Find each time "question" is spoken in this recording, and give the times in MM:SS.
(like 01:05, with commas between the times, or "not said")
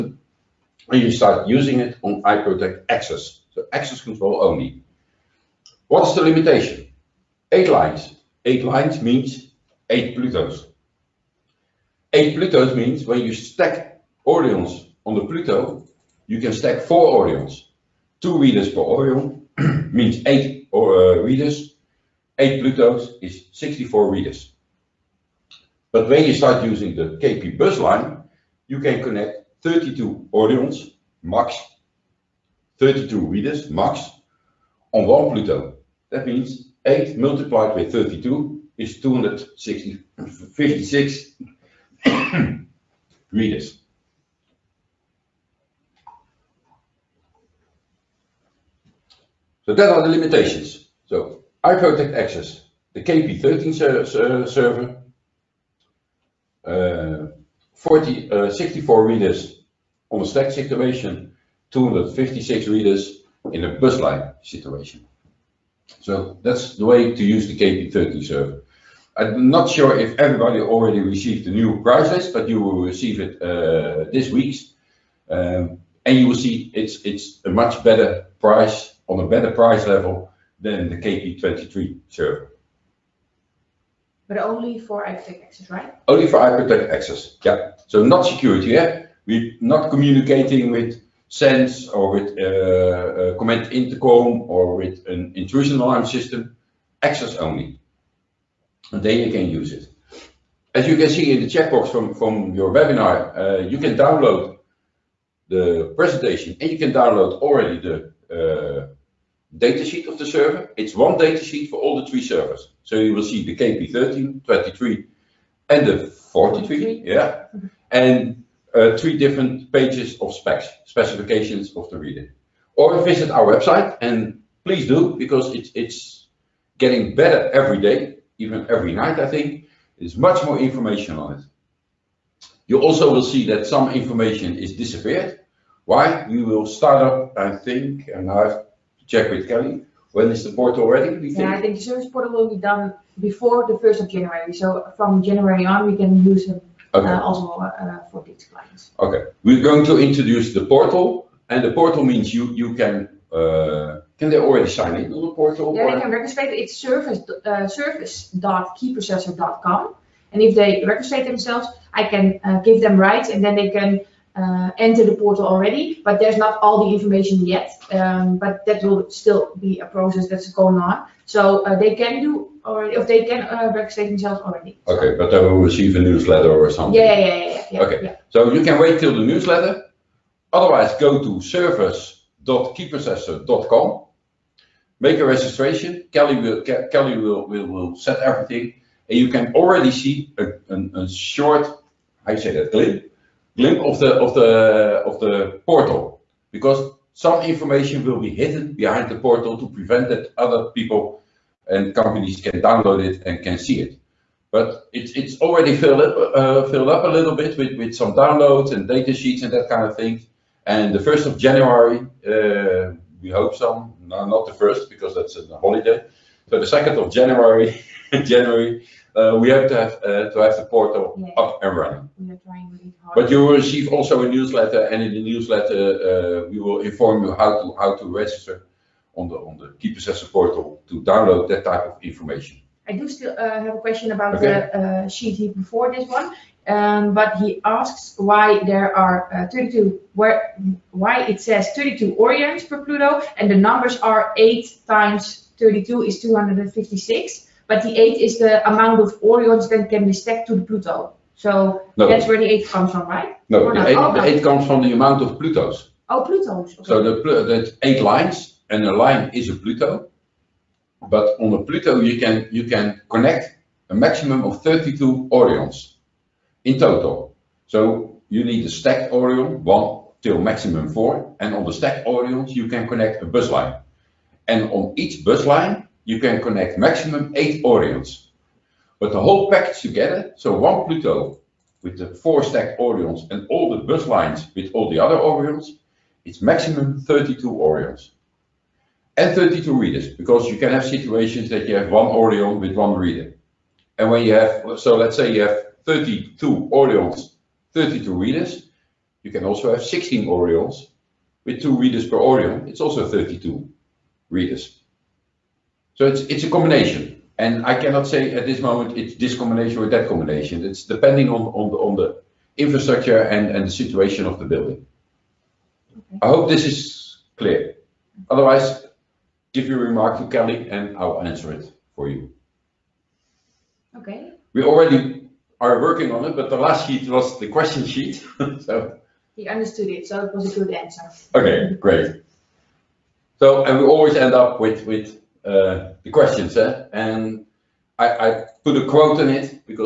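03:53, 05:27, 05:36.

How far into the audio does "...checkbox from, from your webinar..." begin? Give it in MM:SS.
01:41.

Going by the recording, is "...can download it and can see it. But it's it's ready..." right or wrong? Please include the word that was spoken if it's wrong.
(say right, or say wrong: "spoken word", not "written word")
wrong: "already", not "ready".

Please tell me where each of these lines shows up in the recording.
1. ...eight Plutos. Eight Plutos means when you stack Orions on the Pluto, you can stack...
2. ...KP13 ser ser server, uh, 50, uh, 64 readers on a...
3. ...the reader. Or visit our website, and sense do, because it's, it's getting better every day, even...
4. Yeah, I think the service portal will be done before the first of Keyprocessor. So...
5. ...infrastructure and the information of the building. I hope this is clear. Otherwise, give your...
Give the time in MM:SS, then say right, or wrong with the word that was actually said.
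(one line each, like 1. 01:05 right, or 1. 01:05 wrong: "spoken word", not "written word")
1. 00:09 right
2. 00:53 wrong: "40", not "50"
3. 02:01 wrong: "please", not "sense"
4. 02:21 wrong: "January", not "Keyprocessor"
5. 05:12 wrong: "situation", not "information".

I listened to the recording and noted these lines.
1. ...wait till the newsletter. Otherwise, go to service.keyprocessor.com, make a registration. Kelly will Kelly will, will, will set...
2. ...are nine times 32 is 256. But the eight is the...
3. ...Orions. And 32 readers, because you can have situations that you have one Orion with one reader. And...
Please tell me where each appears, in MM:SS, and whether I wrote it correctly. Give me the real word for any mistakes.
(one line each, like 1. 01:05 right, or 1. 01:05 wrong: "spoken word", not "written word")
1. 02:58 right
2. 04:04 wrong: "eight", not "nine"
3. 04:47 right.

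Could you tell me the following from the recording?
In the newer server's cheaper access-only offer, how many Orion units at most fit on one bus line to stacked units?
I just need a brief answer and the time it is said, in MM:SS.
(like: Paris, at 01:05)
8, at 04:37.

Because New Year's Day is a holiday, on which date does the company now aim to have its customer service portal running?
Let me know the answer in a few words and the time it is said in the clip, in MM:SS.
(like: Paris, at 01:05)
2 January, at 03:36.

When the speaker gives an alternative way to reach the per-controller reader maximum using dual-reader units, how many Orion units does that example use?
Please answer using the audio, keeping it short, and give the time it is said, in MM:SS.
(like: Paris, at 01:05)
16, at 04:59.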